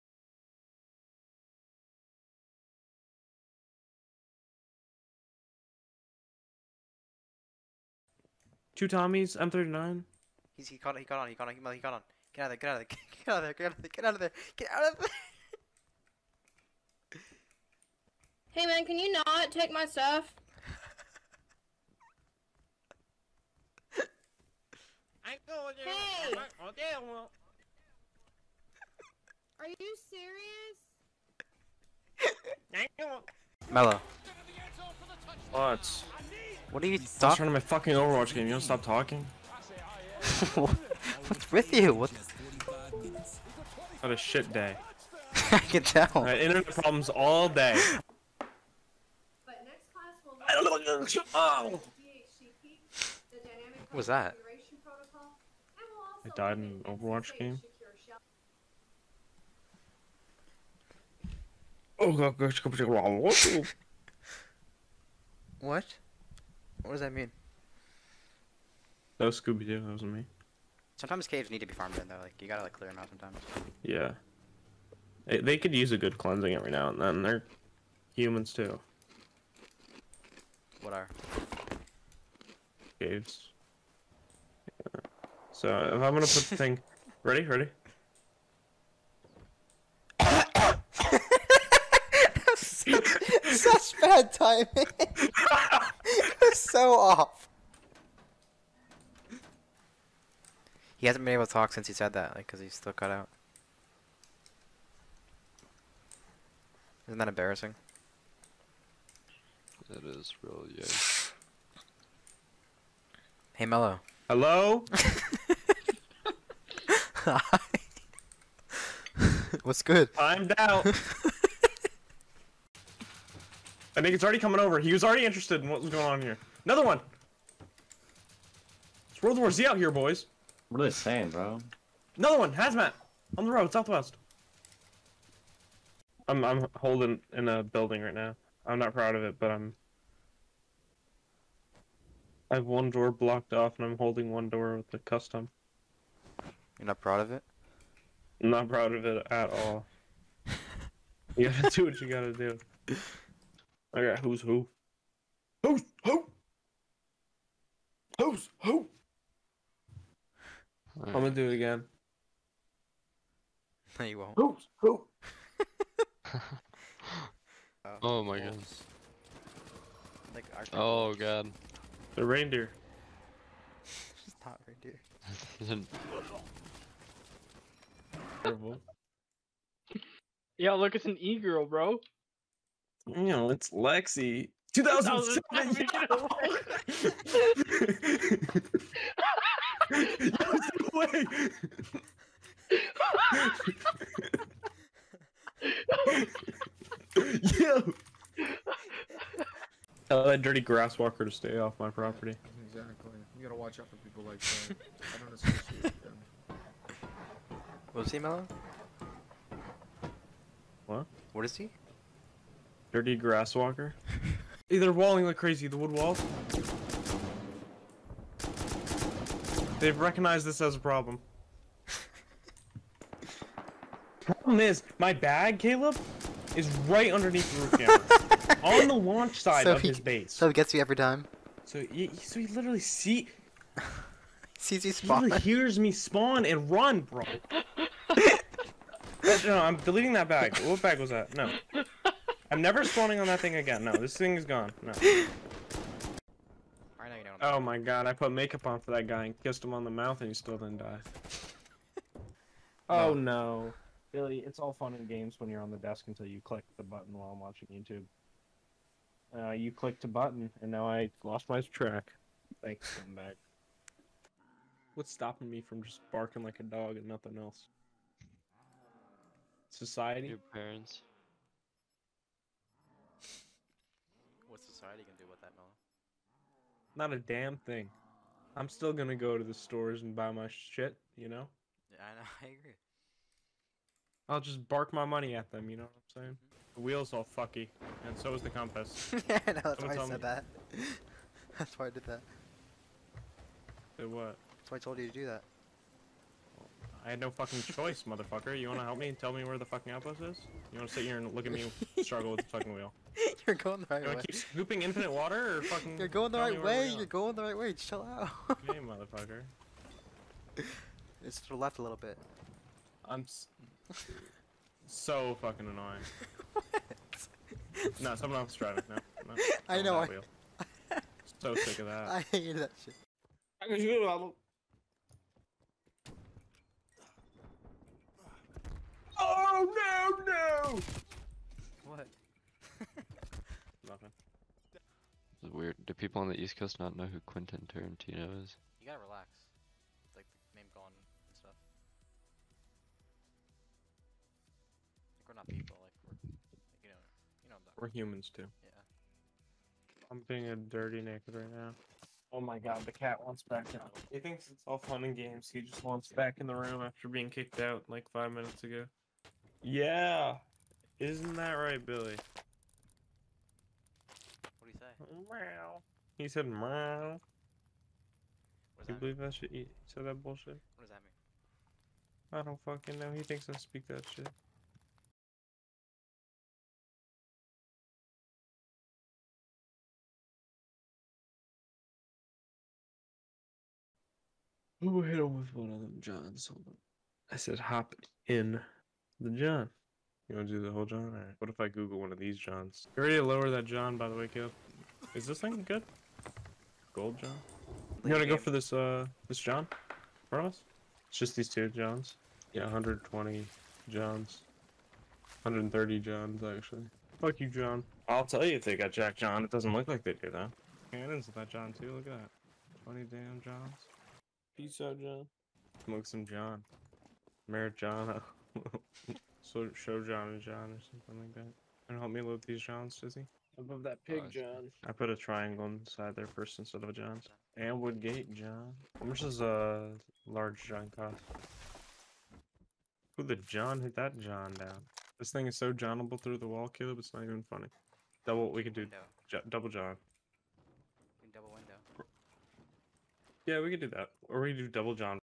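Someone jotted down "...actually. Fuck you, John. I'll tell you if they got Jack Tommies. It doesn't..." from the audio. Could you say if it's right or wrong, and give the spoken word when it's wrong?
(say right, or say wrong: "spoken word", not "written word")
wrong: "John", not "Tommies".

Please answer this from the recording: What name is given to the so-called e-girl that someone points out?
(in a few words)
Lexi.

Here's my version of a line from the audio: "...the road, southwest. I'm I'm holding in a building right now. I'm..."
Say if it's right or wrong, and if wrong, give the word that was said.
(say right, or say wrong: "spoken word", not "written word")
right.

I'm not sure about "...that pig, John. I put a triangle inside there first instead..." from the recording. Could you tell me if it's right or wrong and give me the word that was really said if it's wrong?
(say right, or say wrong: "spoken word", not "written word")
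right.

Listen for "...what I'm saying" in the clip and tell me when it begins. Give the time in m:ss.
4:45.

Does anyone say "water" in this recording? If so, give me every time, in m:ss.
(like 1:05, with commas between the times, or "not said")
5:05.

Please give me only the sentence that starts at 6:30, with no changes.
You want to do the whole John?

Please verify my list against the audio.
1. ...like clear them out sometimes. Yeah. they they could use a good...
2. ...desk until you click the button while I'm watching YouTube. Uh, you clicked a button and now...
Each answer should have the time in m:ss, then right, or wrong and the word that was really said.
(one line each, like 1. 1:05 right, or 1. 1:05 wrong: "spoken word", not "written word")
1. 1:12 right
2. 4:15 right.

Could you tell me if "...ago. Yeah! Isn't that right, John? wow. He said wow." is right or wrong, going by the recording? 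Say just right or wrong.
wrong.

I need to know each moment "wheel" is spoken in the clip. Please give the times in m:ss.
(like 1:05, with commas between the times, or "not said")
4:46, 5:02.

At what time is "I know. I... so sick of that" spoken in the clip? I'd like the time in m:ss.
5:19.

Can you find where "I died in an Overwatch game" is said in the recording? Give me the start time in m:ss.
0:56.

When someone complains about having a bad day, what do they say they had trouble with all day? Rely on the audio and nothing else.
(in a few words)
Internet problems.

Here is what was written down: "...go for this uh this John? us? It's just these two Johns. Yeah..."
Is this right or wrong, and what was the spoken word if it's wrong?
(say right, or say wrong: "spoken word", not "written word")
right.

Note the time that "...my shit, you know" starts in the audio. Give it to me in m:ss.
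4:40.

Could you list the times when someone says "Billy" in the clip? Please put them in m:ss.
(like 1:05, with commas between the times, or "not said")
4:14, 6:01.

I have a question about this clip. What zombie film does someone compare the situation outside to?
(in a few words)
World War Z.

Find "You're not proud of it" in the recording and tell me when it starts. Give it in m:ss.
2:26.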